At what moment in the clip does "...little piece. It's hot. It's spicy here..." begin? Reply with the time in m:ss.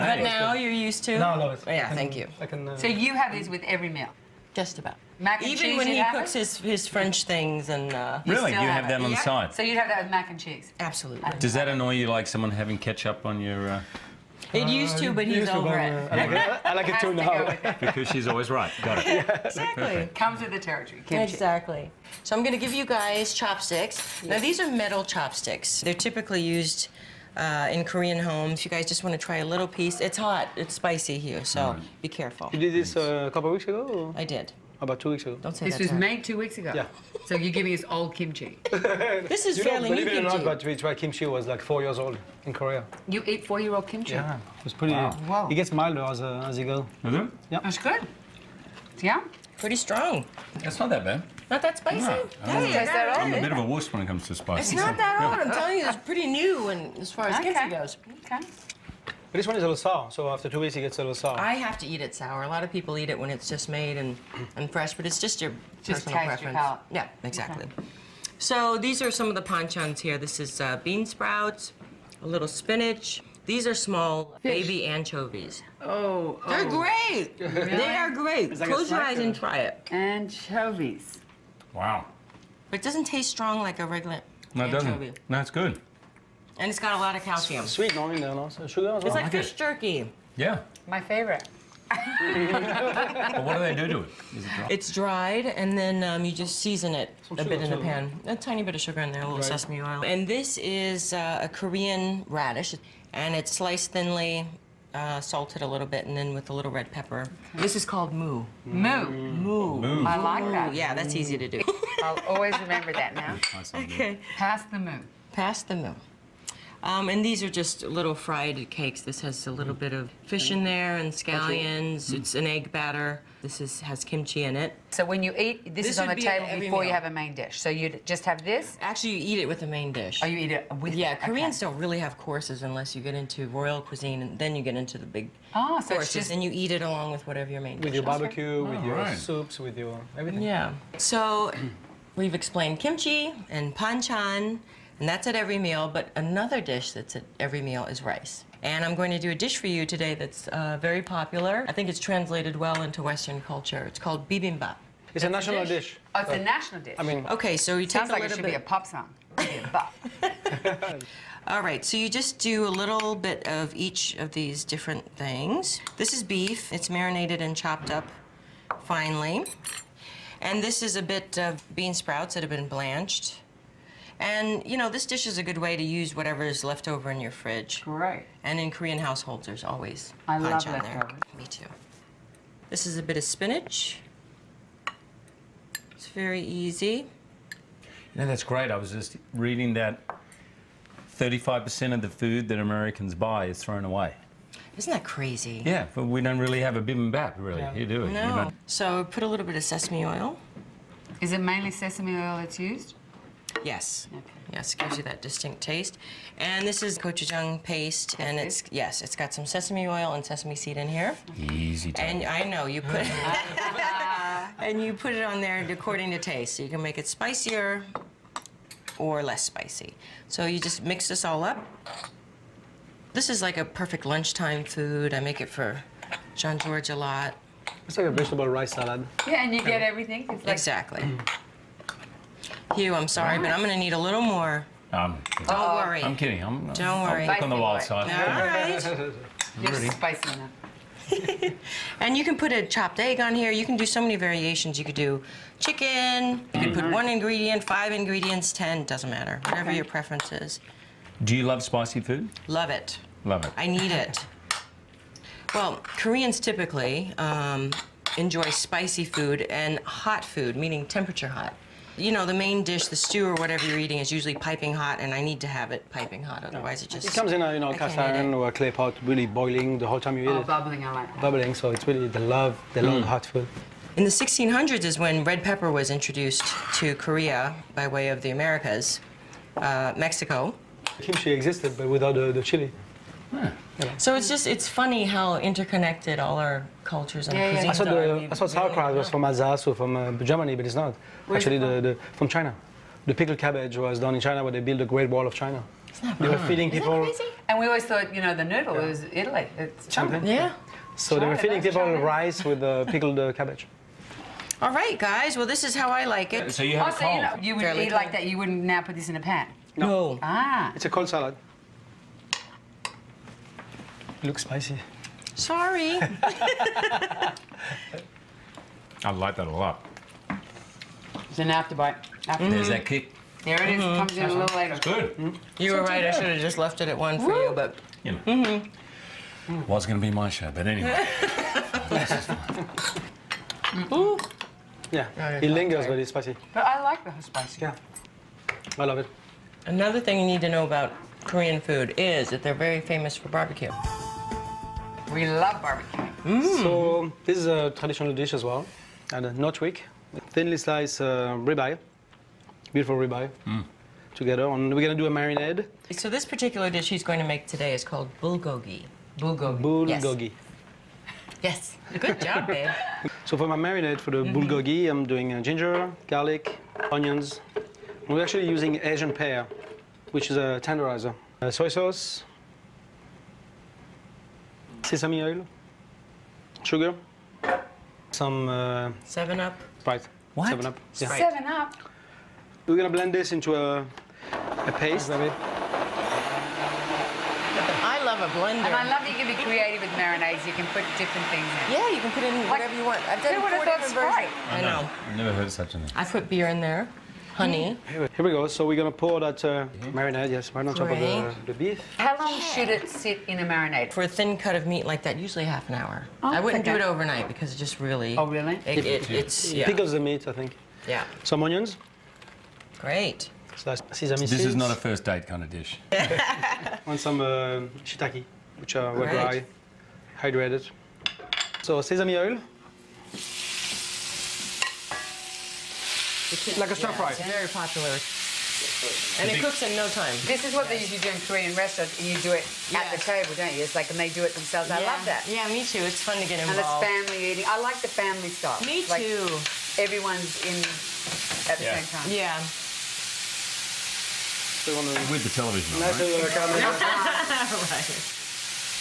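0:29.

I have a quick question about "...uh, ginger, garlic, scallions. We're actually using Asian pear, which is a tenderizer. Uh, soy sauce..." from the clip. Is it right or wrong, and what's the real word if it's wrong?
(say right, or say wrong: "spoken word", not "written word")
wrong: "onions", not "scallions".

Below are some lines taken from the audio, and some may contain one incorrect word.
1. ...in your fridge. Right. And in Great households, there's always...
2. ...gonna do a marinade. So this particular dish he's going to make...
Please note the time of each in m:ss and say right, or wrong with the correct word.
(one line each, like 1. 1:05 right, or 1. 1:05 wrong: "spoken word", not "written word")
1. 2:57 wrong: "Korean", not "Great"
2. 5:54 right.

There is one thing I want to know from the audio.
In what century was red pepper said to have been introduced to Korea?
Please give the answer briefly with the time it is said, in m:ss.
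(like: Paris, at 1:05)
1600s, at 4:34.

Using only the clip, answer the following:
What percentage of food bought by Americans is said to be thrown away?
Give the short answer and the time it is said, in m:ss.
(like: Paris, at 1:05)
35%, at 3:11.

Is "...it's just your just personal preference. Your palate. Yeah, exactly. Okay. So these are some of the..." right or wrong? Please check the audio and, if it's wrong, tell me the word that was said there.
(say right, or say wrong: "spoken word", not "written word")
right.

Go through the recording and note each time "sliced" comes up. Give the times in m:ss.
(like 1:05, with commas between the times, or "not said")
1:43, 5:50.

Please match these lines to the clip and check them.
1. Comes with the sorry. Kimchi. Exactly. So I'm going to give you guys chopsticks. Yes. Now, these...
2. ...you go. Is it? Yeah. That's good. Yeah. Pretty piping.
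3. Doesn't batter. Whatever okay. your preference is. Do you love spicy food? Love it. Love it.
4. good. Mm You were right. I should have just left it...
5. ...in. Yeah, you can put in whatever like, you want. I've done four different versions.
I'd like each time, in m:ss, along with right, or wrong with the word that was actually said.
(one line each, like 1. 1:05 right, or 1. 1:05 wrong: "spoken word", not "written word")
1. 0:20 wrong: "territory", not "sorry"
2. 0:46 wrong: "strong", not "piping"
3. 4:08 wrong: "matter", not "batter"
4. 5:24 right
5. 6:31 right.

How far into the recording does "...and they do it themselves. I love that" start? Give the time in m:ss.
7:13.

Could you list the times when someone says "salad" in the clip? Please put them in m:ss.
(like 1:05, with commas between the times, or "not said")
3:48, 5:11.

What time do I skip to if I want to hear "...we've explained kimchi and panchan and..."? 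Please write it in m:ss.
2:22.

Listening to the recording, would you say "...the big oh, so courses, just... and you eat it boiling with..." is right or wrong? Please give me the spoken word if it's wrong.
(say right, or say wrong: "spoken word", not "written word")
wrong: "along", not "boiling".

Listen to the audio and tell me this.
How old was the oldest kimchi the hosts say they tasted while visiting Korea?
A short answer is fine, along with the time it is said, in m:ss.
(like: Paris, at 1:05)
4 years old, at 0:41.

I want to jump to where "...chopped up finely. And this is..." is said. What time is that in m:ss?
2:47.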